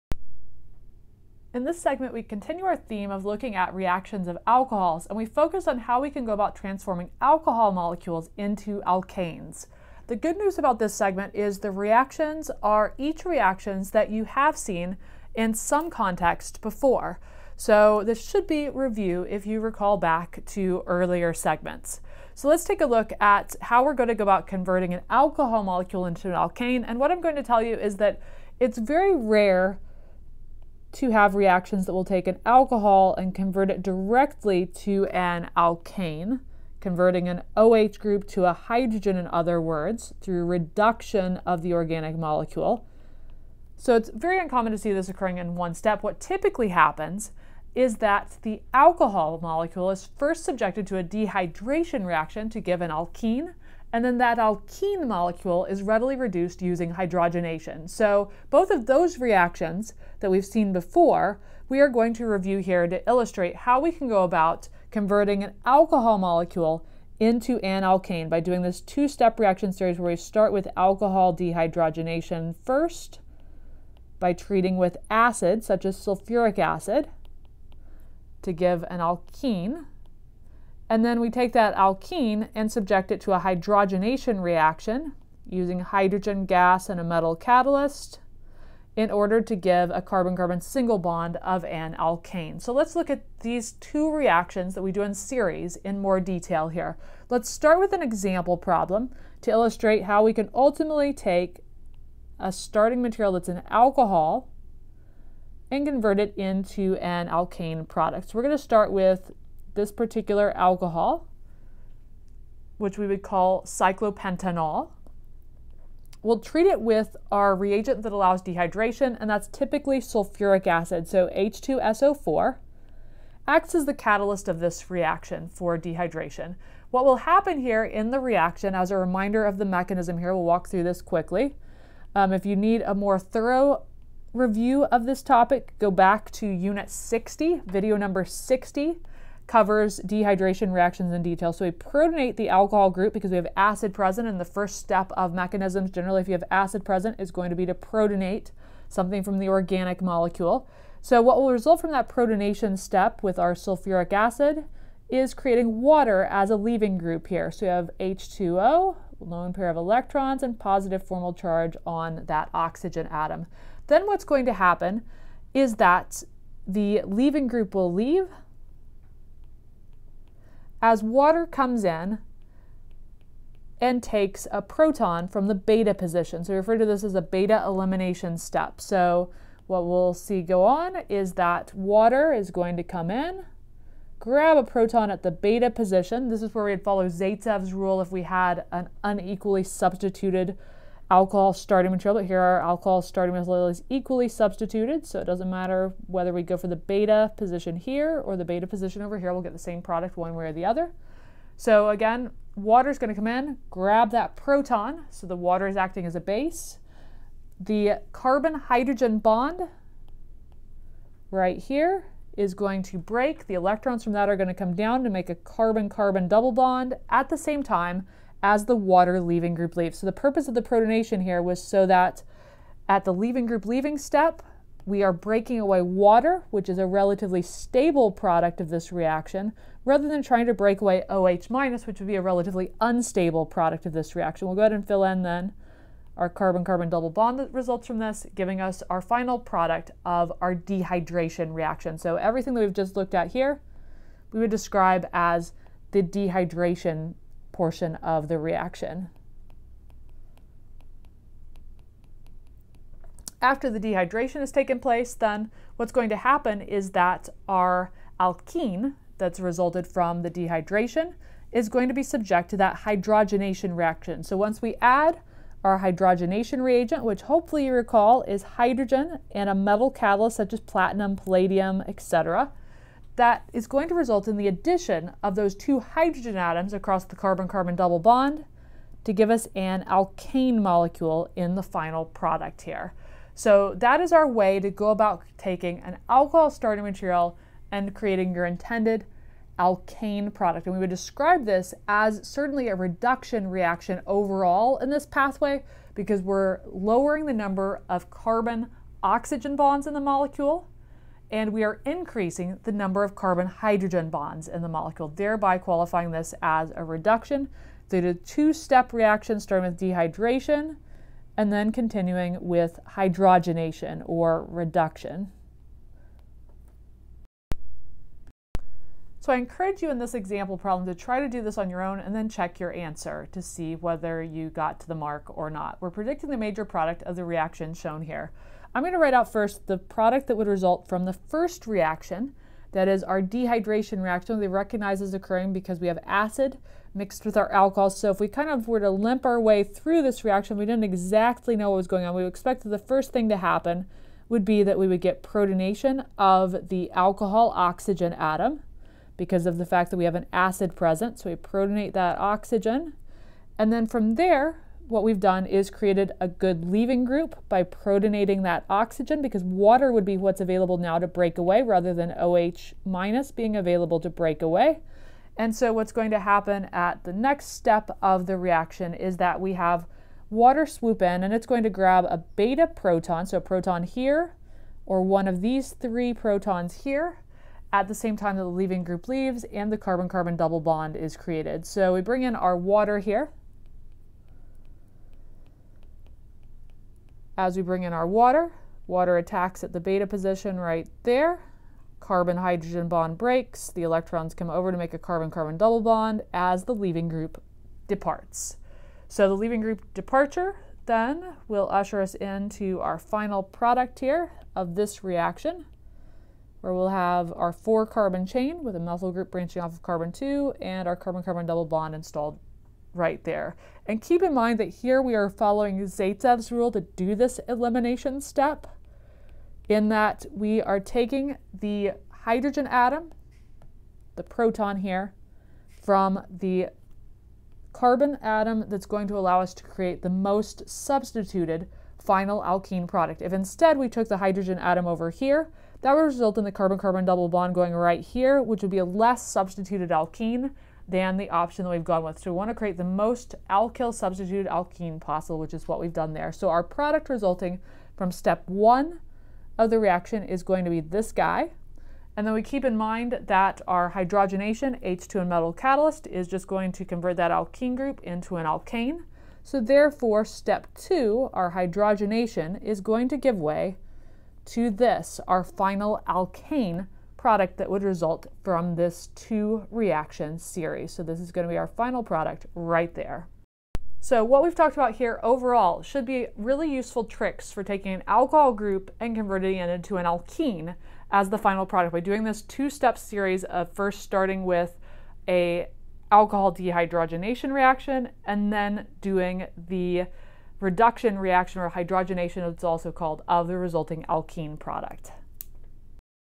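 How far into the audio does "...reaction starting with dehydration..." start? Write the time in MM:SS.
05:08.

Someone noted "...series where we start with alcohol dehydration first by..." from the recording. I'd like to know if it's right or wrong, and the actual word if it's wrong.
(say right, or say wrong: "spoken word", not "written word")
right.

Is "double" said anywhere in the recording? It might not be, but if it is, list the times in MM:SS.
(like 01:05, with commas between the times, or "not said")
03:36, 03:56, 04:37, 06:20, 06:35, 06:51, 07:17.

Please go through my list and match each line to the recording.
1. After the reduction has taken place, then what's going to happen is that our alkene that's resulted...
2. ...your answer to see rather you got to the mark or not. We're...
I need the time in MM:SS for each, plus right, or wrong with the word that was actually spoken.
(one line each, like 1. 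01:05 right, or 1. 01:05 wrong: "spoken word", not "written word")
1. 04:13 wrong: "dehydration", not "reduction"
2. 05:22 wrong: "whether", not "rather".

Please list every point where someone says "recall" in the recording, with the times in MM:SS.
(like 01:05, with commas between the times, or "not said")
00:19, 04:27.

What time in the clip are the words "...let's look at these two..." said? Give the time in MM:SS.
01:32.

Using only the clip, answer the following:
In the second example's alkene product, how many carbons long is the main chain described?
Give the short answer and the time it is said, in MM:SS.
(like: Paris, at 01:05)
4, at 06:47.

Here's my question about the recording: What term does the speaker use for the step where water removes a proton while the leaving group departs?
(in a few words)
beta elimination.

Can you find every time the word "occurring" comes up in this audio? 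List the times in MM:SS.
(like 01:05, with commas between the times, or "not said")
00:45, 05:35.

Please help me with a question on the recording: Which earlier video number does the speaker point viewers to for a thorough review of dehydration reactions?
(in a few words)
60.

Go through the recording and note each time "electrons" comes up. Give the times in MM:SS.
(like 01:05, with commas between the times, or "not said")
02:39, 03:33, 06:33.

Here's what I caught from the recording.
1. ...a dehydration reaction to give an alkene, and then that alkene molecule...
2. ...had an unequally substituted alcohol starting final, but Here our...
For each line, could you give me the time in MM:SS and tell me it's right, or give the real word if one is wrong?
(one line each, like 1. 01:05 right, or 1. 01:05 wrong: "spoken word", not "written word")
1. 00:50 right
2. 03:08 wrong: "material", not "final".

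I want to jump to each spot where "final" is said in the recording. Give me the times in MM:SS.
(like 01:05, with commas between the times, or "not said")
03:59, 04:41, 06:42, 07:12, 07:45, 07:51, 08:01.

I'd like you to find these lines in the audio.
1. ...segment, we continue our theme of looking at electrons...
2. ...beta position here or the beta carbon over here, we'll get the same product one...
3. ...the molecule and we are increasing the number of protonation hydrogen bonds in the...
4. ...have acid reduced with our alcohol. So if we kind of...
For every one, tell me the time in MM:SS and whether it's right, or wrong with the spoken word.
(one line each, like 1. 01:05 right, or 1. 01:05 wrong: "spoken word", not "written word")
1. 00:01 wrong: "reactions", not "electrons"
2. 03:16 wrong: "position", not "carbon"
3. 04:59 wrong: "carbon", not "protonation"
4. 05:35 wrong: "mixed", not "reduced".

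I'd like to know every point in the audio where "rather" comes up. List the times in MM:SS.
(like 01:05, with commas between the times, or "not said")
03:49, 06:01.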